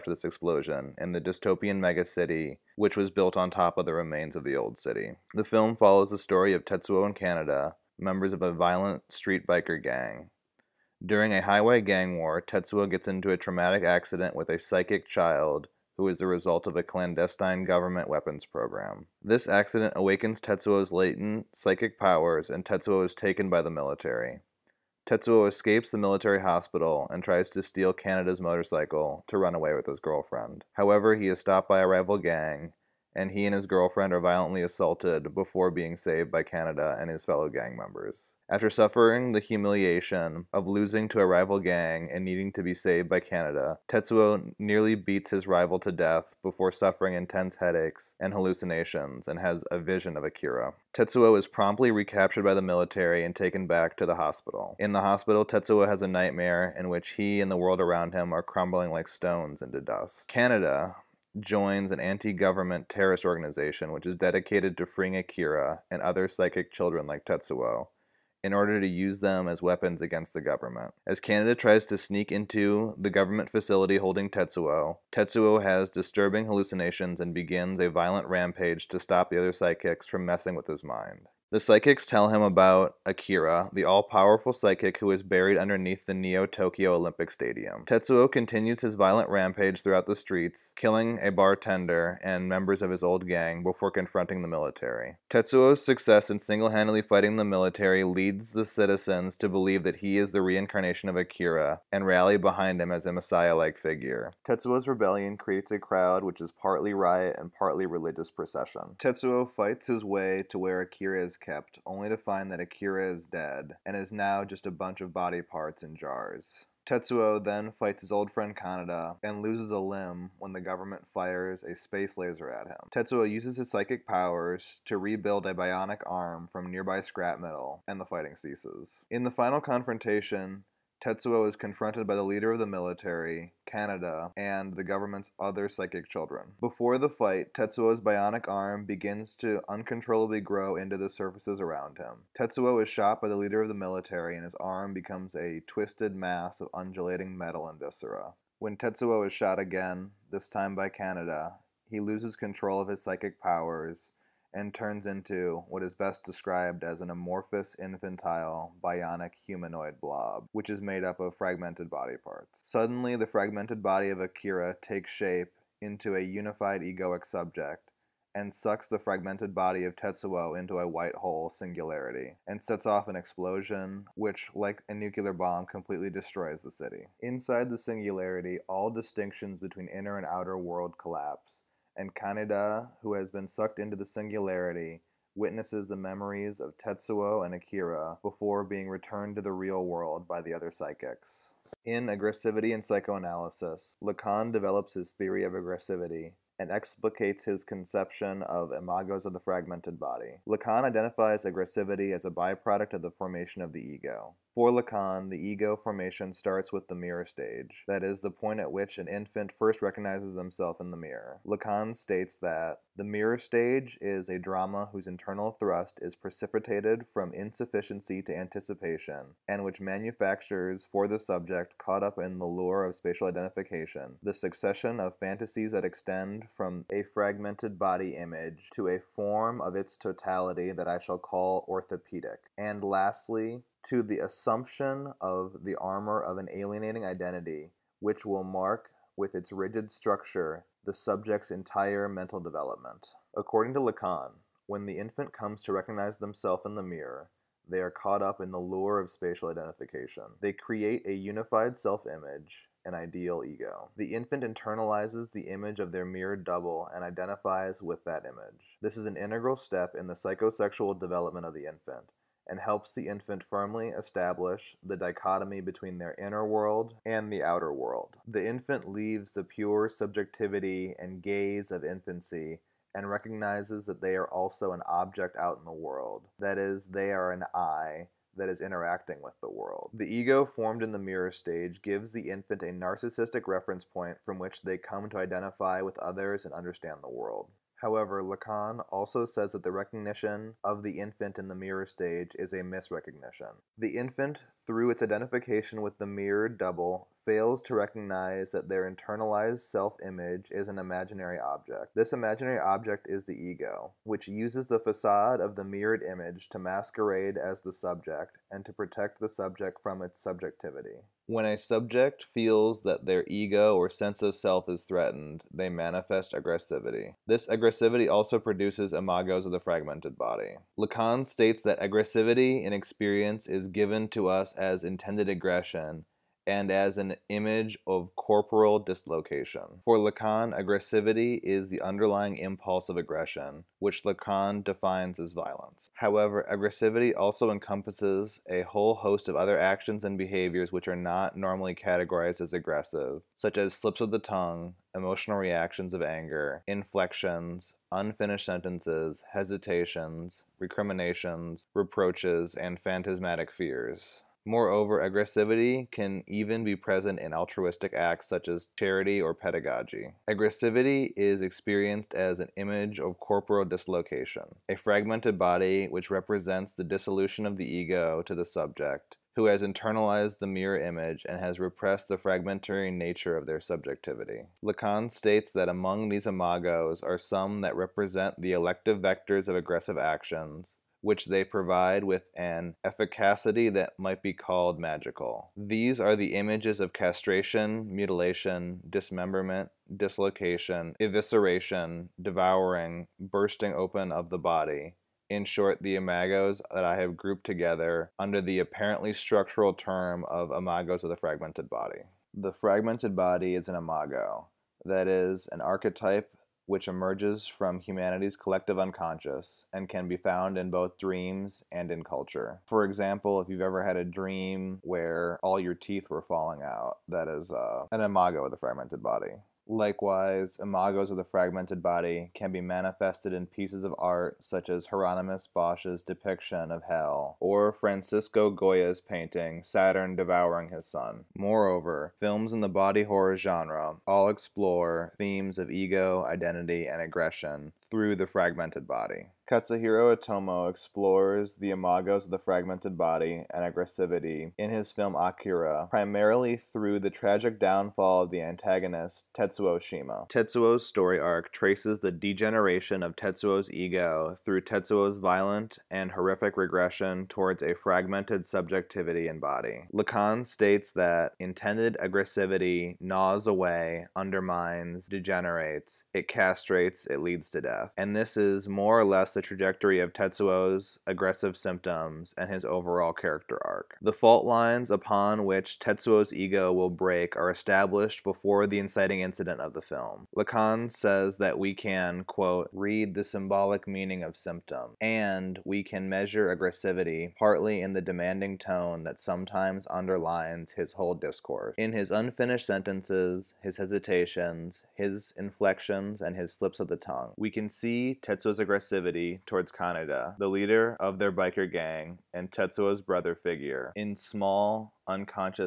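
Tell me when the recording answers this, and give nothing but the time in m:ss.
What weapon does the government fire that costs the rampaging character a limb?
2:01.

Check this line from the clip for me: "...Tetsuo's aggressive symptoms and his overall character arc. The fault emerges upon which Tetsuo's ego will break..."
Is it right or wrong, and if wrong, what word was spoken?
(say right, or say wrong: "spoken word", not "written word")
wrong: "lines", not "emerges".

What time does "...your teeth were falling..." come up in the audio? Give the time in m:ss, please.
6:55.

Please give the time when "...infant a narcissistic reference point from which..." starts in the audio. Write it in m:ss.
4:42.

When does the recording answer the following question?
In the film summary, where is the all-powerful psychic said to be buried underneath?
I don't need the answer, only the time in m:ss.
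1:26.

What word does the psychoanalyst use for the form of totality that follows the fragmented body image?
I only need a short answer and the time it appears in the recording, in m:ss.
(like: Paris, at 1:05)
Orthopedic, at 3:51.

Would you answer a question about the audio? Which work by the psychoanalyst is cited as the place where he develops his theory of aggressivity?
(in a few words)
Aggressivity and Psychoanalysis.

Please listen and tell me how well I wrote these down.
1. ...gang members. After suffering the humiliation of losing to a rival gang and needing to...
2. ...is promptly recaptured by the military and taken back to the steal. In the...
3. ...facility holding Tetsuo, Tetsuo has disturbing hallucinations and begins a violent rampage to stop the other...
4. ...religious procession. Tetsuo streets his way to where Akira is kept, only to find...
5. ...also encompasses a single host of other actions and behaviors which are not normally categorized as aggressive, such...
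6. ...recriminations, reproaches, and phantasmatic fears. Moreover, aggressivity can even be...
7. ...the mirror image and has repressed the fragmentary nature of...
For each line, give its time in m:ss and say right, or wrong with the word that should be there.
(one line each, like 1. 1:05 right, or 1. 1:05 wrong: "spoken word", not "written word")
1. 0:37 right
2. 0:51 wrong: "hospital", not "steal"
3. 1:13 right
4. 1:47 wrong: "fights", not "streets"
5. 5:37 wrong: "whole", not "single"
6. 5:50 right
7. 6:10 right.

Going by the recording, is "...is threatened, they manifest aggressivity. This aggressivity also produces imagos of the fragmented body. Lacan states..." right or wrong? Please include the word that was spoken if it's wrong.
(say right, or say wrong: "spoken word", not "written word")
right.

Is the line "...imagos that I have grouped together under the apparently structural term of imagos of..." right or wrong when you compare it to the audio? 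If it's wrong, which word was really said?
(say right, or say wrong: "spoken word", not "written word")
right.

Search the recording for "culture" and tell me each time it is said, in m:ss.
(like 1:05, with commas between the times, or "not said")
6:52.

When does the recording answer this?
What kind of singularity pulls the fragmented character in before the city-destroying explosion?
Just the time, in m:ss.
2:50.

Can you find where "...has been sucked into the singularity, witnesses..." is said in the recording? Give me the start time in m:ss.
3:03.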